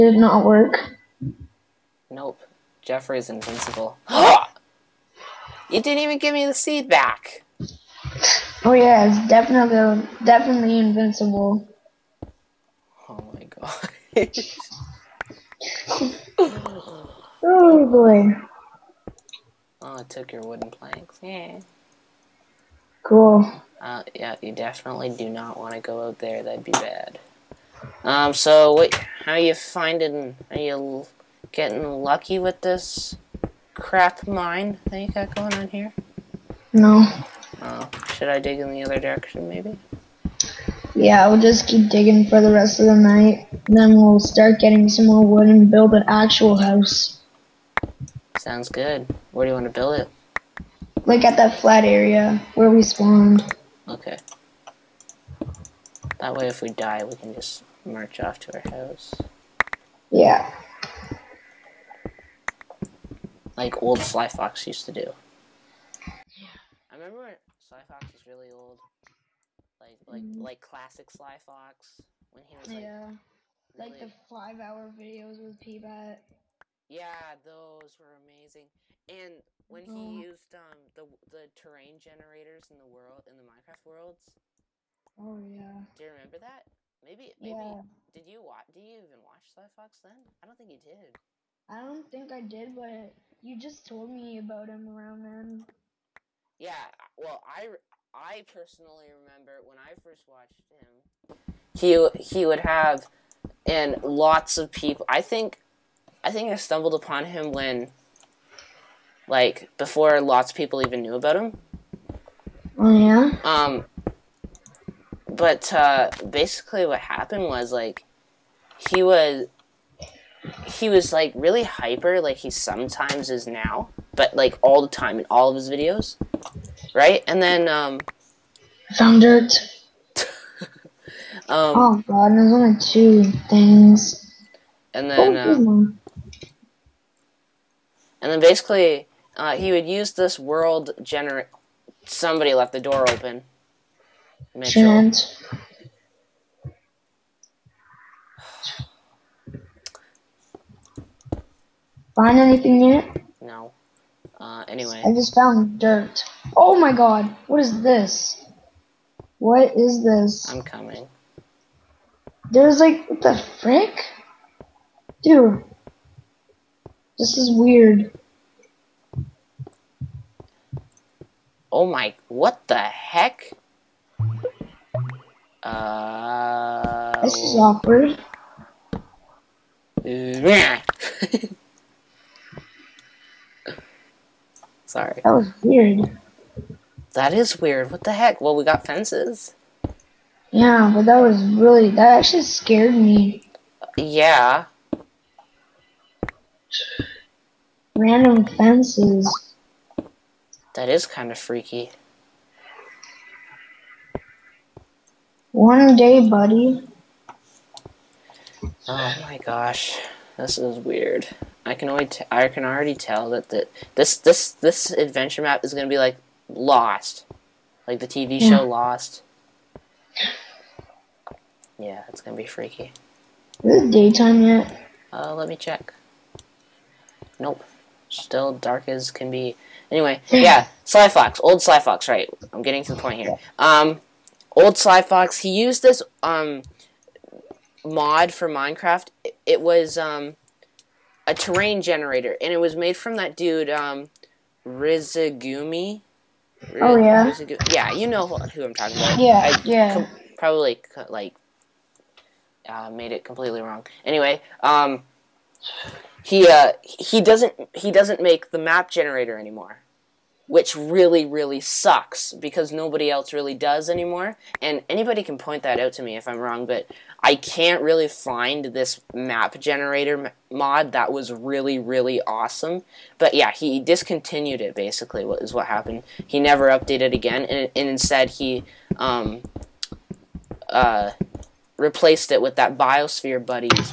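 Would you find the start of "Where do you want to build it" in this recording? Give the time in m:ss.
0:49.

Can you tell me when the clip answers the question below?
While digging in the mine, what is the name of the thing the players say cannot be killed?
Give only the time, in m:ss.
0:02.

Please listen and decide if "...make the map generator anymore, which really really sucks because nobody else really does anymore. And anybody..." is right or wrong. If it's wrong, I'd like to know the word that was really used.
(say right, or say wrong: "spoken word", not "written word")
right.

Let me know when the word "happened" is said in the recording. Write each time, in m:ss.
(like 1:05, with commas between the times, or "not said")
1:56, 4:35.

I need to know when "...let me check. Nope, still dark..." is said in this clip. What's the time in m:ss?
3:45.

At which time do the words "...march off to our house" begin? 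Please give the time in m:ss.
0:57.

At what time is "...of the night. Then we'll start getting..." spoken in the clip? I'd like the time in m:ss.
0:42.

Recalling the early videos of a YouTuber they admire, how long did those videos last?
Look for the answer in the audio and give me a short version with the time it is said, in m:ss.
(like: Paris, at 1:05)
5 hours, at 1:14.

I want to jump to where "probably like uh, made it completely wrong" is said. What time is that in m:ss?
4:10.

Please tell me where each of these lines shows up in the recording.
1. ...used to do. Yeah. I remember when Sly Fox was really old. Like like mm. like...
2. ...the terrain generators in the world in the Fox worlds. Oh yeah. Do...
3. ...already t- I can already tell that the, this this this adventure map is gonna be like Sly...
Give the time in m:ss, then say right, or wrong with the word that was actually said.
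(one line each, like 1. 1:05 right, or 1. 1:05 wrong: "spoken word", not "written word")
1. 1:04 right
2. 1:21 wrong: "Minecraft", not "Fox"
3. 3:31 wrong: "Lost", not "Sly".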